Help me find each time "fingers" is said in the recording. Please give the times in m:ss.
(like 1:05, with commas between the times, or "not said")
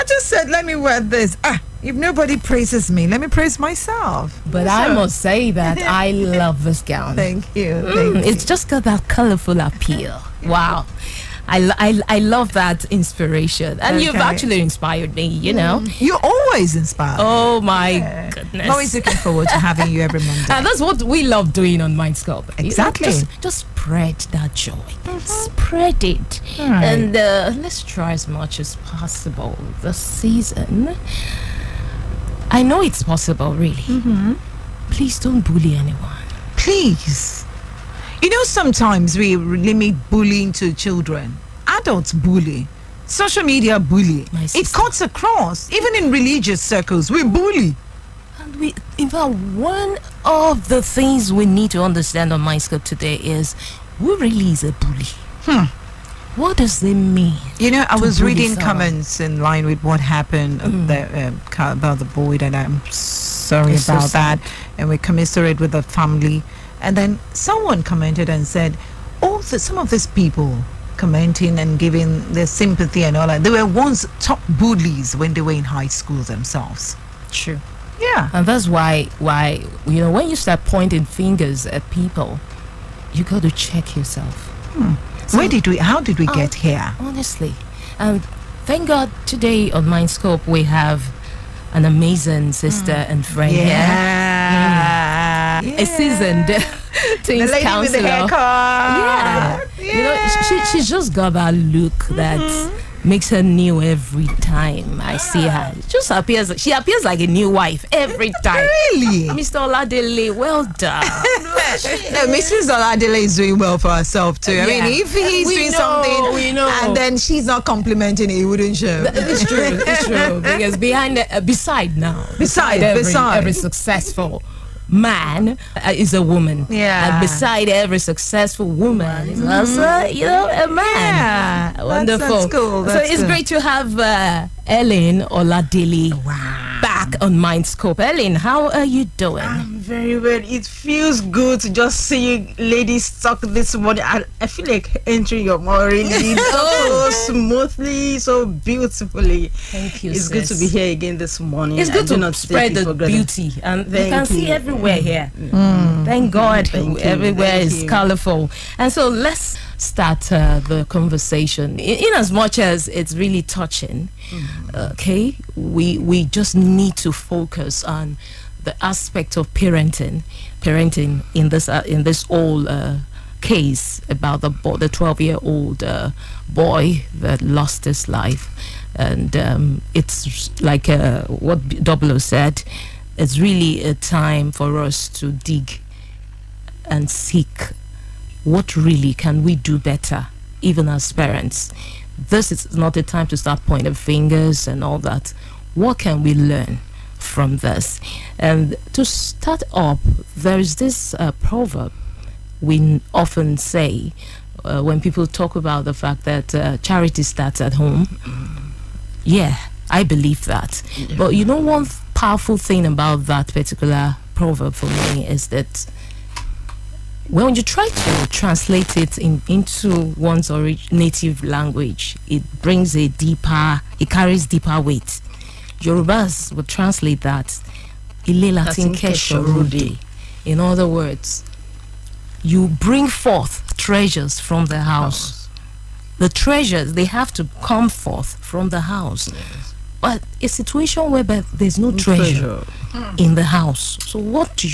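1:21, 3:13.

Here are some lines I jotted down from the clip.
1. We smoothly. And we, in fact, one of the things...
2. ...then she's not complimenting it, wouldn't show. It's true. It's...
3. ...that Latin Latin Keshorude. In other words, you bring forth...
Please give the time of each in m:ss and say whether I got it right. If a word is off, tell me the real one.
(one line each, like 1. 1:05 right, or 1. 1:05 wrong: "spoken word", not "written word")
1. 0:47 wrong: "bully", not "smoothly"
2. 1:56 right
3. 3:47 wrong: "Ile", not "Latin".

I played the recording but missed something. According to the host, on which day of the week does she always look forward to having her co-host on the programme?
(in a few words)
Monday.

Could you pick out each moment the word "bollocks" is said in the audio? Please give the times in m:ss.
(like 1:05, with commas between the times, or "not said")
not said.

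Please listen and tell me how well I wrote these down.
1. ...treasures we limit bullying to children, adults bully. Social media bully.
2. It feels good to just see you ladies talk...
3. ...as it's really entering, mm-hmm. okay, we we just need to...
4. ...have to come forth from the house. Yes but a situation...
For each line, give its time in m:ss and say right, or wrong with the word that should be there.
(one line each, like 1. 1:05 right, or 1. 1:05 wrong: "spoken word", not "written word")
1. 0:38 wrong: "sometimes", not "treasures"
2. 2:20 right
3. 2:42 wrong: "touching", not "entering"
4. 3:57 right.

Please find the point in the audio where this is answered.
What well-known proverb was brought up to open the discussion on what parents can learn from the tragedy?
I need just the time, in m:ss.
3:26.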